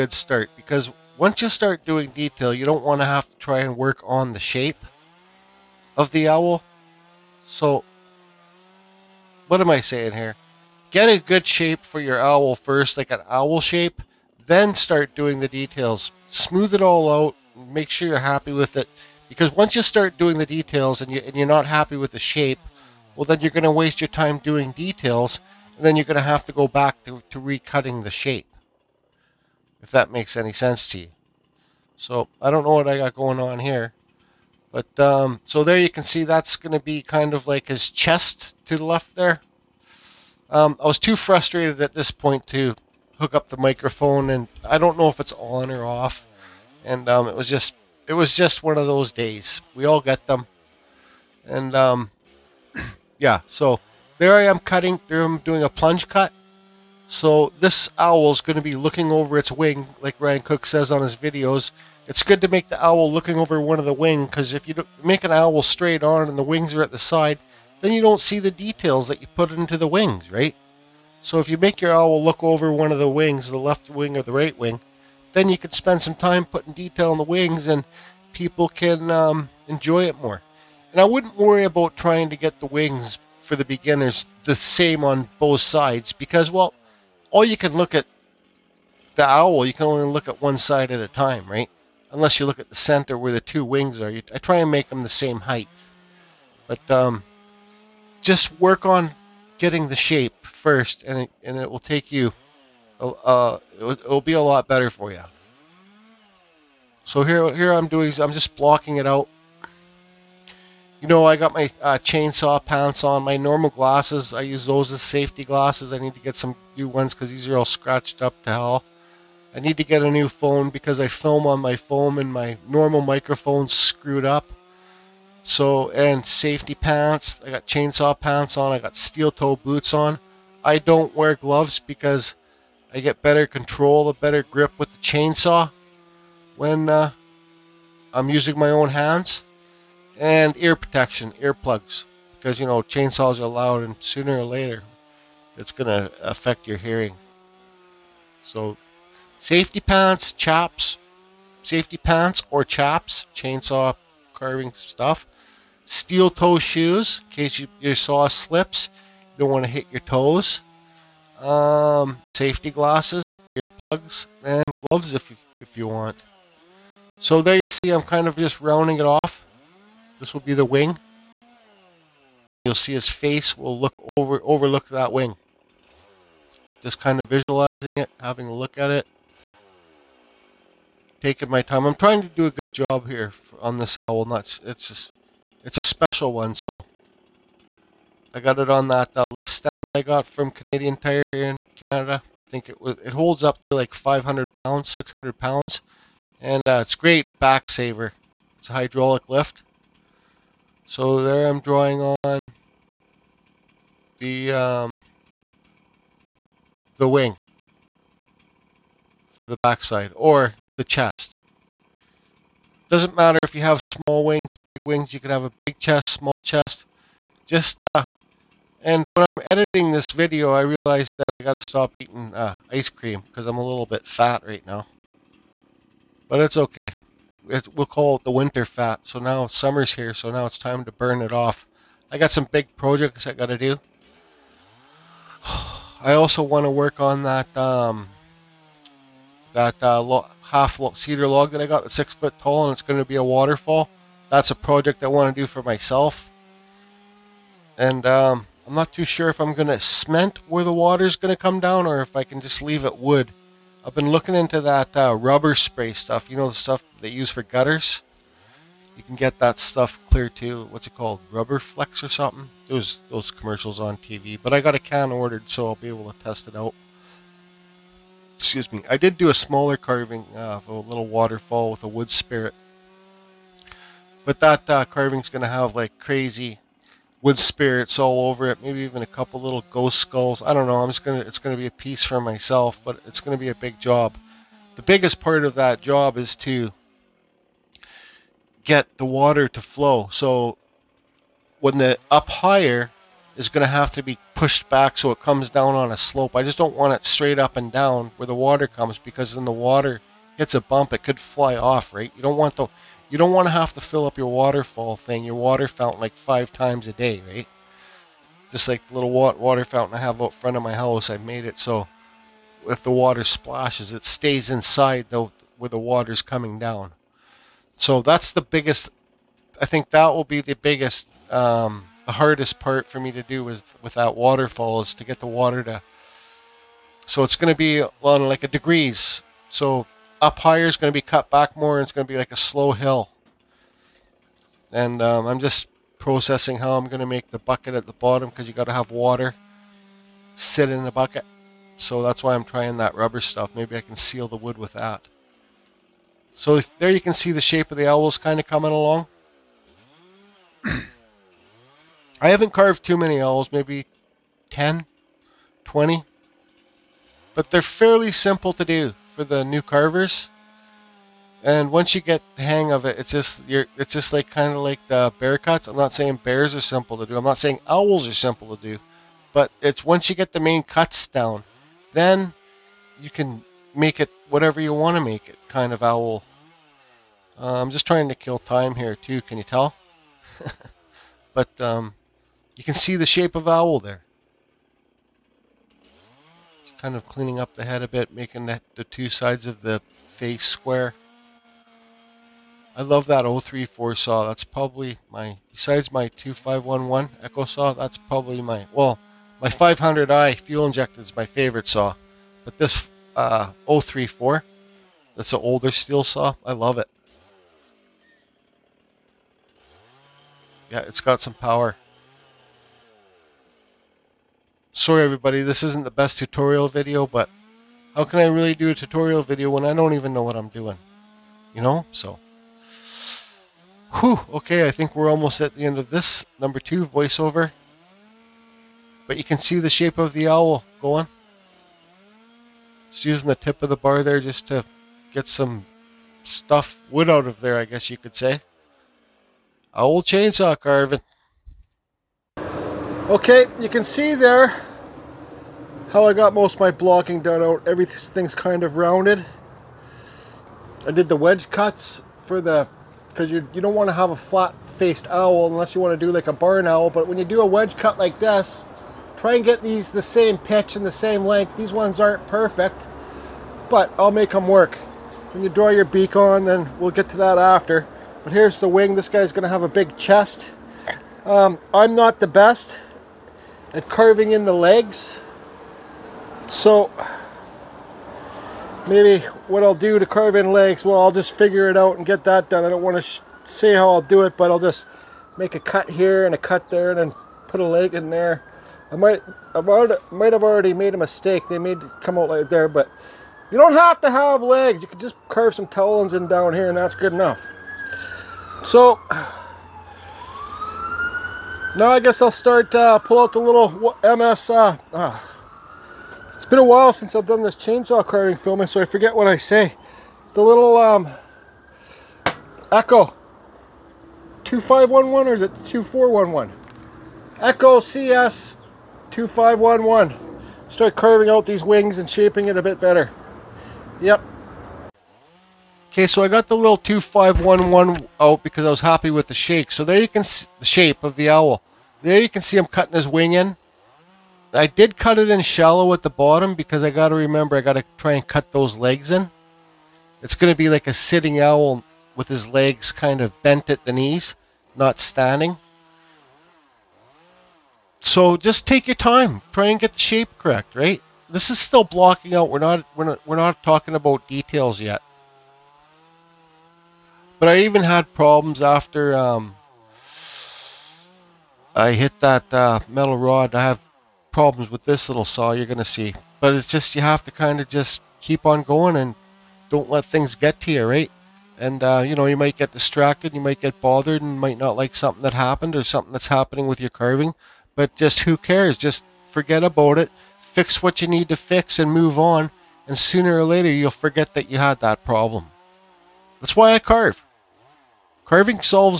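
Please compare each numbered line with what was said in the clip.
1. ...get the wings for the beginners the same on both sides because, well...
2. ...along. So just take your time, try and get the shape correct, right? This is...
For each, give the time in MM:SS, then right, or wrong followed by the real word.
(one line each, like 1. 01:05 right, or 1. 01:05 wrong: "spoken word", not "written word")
1. 01:22 right
2. 09:04 wrong: "standing", not "along".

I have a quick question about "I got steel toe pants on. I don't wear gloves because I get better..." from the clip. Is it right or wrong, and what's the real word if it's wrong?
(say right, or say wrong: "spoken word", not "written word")
wrong: "boots", not "pants".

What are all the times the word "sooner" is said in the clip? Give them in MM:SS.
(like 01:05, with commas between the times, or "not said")
02:23, 09:42.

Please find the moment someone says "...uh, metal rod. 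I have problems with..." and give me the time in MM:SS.
09:22.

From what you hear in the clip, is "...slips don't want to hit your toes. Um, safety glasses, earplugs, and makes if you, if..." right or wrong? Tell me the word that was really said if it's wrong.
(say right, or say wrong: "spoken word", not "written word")
wrong: "gloves", not "makes".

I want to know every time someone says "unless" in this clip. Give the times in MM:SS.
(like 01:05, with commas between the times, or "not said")
01:32, 07:35.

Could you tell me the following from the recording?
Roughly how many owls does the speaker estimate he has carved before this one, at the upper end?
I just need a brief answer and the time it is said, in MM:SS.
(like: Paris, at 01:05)
20, at 05:55.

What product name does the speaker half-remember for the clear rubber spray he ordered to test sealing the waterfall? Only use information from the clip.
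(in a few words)
Rubber Flex.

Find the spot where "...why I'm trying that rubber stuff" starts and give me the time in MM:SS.
05:42.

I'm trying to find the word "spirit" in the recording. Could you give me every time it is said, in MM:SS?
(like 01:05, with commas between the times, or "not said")
04:32, 04:37.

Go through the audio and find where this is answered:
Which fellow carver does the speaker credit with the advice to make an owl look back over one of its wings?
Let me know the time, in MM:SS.
01:00.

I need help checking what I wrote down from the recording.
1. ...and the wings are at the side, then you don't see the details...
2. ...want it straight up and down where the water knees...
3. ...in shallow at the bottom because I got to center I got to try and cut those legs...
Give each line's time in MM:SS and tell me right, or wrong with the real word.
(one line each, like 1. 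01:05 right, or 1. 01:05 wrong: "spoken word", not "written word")
1. 01:06 right
2. 04:56 wrong: "comes", not "knees"
3. 08:55 wrong: "remember", not "center".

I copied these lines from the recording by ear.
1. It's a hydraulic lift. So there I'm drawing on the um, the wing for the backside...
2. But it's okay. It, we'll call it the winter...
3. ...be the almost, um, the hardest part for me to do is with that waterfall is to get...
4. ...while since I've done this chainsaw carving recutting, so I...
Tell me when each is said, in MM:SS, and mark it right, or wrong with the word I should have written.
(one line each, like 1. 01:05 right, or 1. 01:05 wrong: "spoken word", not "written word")
1. 03:18 right
2. 03:46 right
3. 05:20 wrong: "biggest", not "almost"
4. 08:26 wrong: "filming", not "recutting".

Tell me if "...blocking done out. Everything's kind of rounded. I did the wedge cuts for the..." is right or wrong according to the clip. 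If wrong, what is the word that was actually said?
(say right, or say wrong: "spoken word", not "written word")
right.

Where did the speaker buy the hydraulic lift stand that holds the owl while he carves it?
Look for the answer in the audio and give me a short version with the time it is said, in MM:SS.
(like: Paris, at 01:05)
Canadian Tire, at 03:10.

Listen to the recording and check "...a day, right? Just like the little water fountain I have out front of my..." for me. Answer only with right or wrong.
right.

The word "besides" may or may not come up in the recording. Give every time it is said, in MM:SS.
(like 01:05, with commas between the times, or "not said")
06:35.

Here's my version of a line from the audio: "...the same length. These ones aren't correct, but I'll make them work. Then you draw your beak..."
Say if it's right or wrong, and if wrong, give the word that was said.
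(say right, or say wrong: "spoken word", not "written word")
wrong: "perfect", not "correct".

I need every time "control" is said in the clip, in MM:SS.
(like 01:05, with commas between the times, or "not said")
02:13.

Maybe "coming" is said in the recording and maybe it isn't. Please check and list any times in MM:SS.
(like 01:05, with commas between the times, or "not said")
05:16, 05:48.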